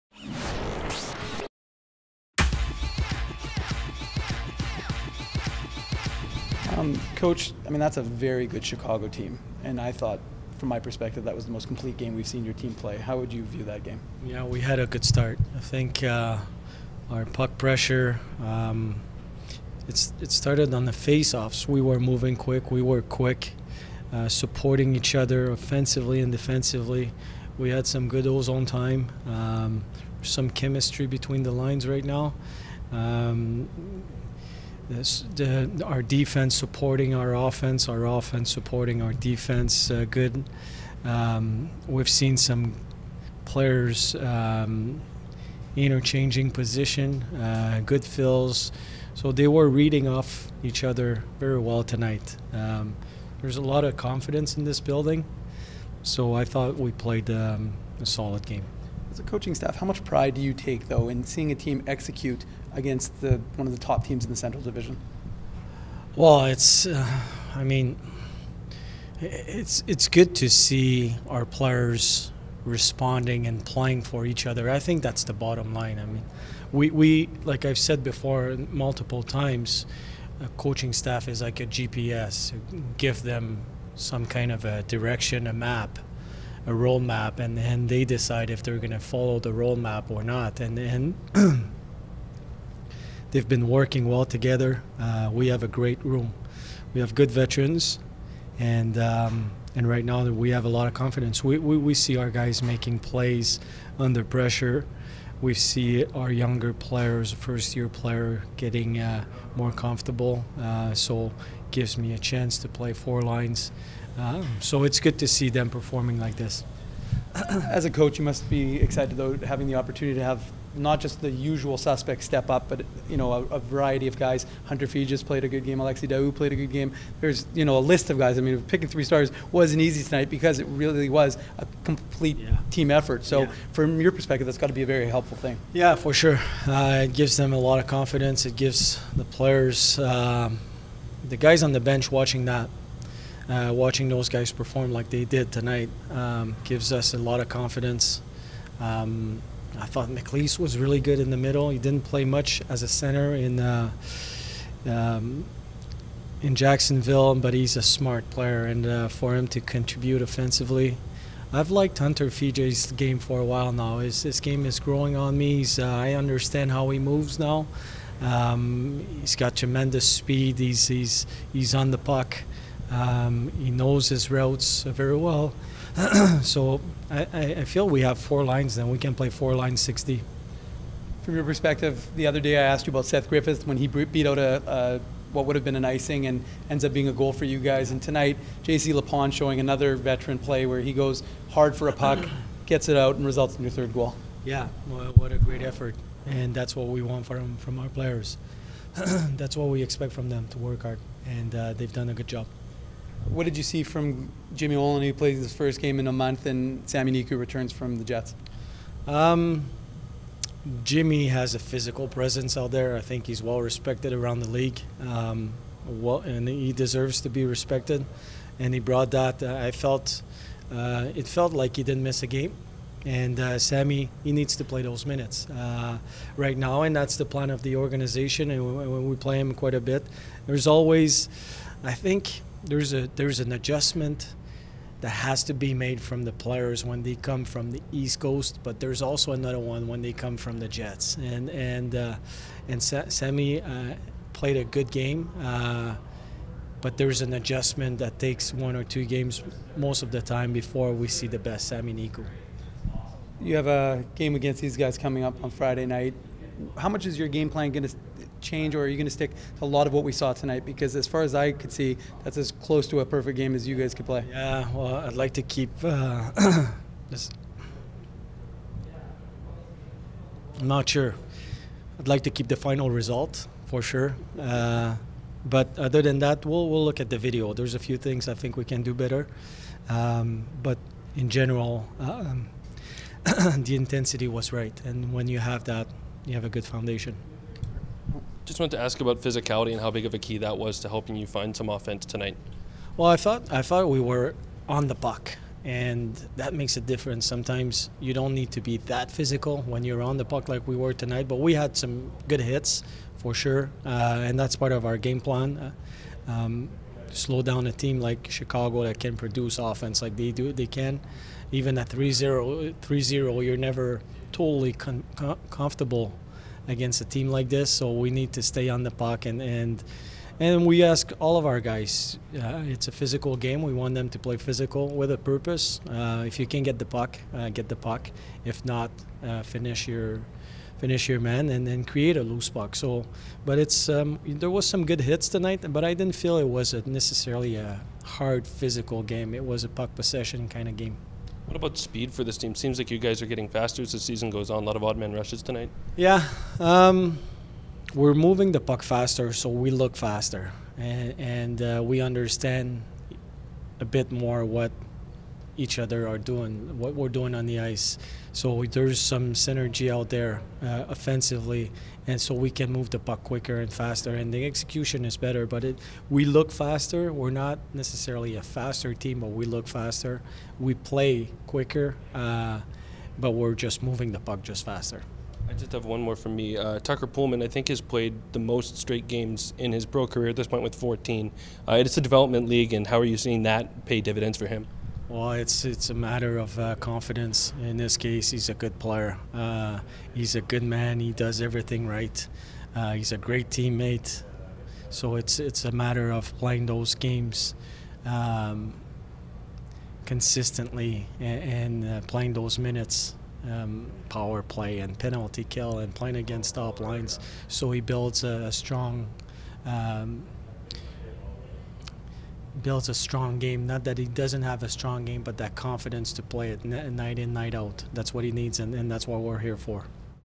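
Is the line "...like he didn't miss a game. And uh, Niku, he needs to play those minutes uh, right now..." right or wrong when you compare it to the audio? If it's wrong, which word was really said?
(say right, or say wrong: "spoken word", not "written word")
wrong: "Sami", not "Niku".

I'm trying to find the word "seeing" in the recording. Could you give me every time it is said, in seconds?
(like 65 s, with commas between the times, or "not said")
61 s, 383 s.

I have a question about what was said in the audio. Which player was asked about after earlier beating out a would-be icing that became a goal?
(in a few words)
Seth Griffith.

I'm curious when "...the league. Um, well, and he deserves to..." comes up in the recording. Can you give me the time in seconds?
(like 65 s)
214 s.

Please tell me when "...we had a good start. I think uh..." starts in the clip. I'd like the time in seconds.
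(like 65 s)
14 s.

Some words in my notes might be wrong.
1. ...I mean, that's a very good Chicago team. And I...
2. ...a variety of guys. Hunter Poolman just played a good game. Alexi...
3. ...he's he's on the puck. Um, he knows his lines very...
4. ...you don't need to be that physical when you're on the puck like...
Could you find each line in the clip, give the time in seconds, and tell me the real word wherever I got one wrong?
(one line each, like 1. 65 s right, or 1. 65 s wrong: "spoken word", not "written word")
1. 7 s right
2. 123 s wrong: "Fee", not "Poolman"
3. 170 s wrong: "routes", not "lines"
4. 297 s right.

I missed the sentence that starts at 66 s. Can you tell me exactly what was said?
Well, it's, uh, I mean, it's it's good to see our players responding and playing for each other.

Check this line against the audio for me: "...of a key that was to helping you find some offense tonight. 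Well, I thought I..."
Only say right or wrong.
right.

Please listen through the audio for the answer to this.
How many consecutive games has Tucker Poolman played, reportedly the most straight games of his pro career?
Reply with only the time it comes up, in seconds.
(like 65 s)
380 s.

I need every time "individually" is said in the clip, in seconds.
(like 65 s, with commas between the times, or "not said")
not said.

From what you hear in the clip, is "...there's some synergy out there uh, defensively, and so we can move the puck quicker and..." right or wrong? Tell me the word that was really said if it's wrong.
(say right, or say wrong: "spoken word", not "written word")
wrong: "offensively", not "defensively".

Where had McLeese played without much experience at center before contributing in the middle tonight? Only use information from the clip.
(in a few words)
Jacksonville.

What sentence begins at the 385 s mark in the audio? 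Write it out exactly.
Well, it's it's a matter of uh, confidence.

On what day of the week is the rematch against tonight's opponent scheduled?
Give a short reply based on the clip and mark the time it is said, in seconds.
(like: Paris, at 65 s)
Friday, at 255 s.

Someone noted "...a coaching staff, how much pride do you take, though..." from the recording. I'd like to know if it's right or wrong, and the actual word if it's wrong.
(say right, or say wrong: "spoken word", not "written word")
right.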